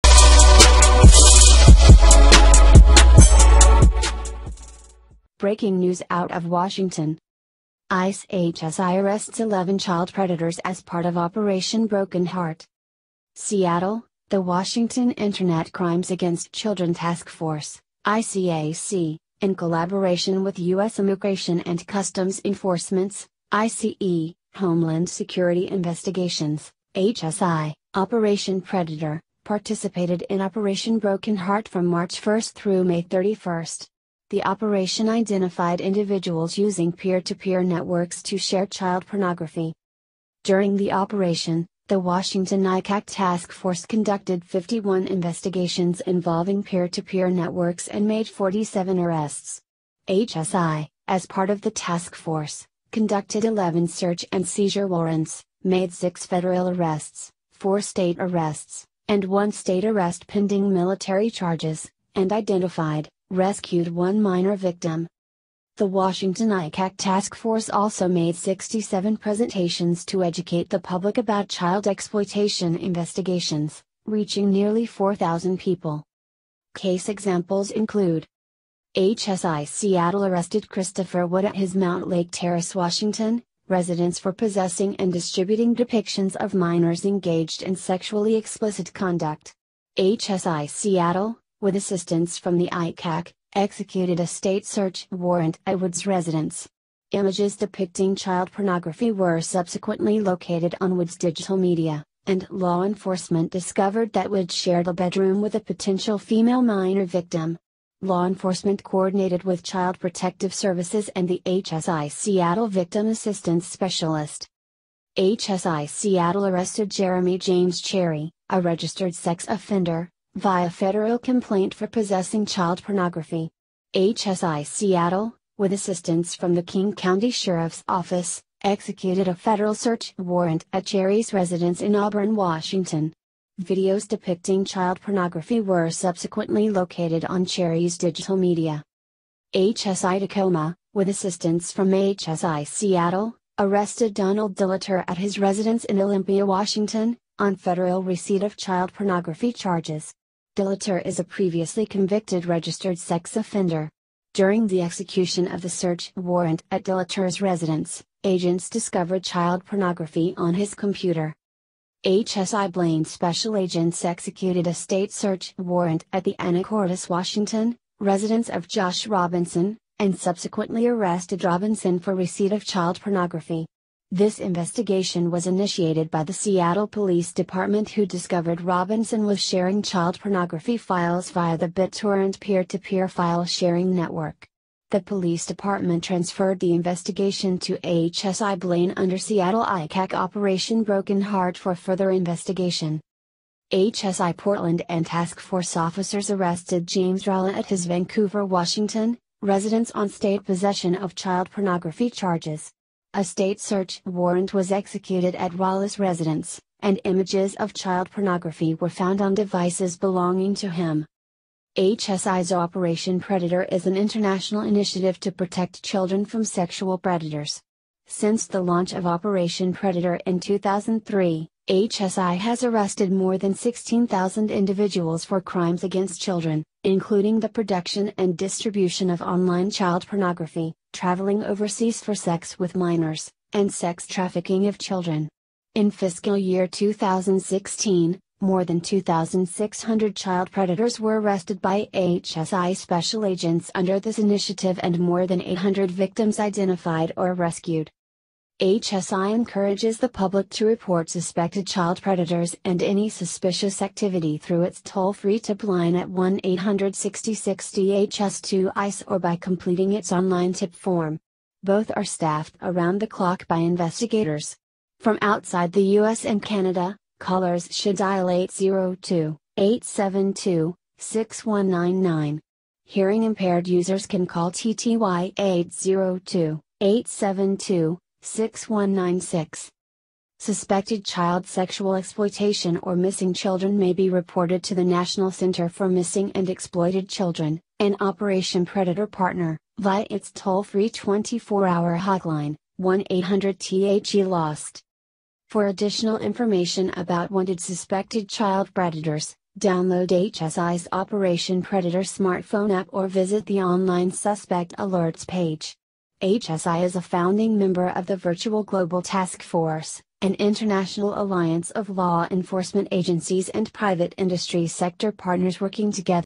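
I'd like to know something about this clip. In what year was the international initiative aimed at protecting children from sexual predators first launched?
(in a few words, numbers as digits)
2003.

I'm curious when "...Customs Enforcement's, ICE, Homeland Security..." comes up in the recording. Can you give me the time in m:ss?
0:21.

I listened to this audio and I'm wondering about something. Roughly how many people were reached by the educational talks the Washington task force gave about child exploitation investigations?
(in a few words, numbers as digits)
nearly 4,000.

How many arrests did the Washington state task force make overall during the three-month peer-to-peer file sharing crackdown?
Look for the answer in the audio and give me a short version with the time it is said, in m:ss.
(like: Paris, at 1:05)
47, at 0:48.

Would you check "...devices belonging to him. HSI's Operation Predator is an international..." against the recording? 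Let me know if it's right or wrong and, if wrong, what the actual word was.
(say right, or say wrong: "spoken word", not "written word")
right.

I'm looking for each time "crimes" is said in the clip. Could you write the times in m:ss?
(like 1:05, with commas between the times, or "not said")
0:15, 3:45.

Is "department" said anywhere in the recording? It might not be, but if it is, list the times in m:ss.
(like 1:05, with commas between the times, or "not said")
2:57, 3:05.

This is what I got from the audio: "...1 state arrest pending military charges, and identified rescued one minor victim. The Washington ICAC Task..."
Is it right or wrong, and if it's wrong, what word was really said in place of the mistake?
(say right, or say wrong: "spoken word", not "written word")
right.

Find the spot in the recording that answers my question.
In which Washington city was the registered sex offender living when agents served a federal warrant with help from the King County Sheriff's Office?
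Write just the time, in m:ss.
2:11.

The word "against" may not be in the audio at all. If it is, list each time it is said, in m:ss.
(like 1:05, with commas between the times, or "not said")
0:16, 3:45.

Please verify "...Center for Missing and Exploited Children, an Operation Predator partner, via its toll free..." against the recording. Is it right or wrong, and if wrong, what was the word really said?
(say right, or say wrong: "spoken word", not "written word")
right.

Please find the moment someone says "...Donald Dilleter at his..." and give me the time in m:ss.
2:24.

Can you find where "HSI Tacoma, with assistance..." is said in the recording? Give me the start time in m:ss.
2:19.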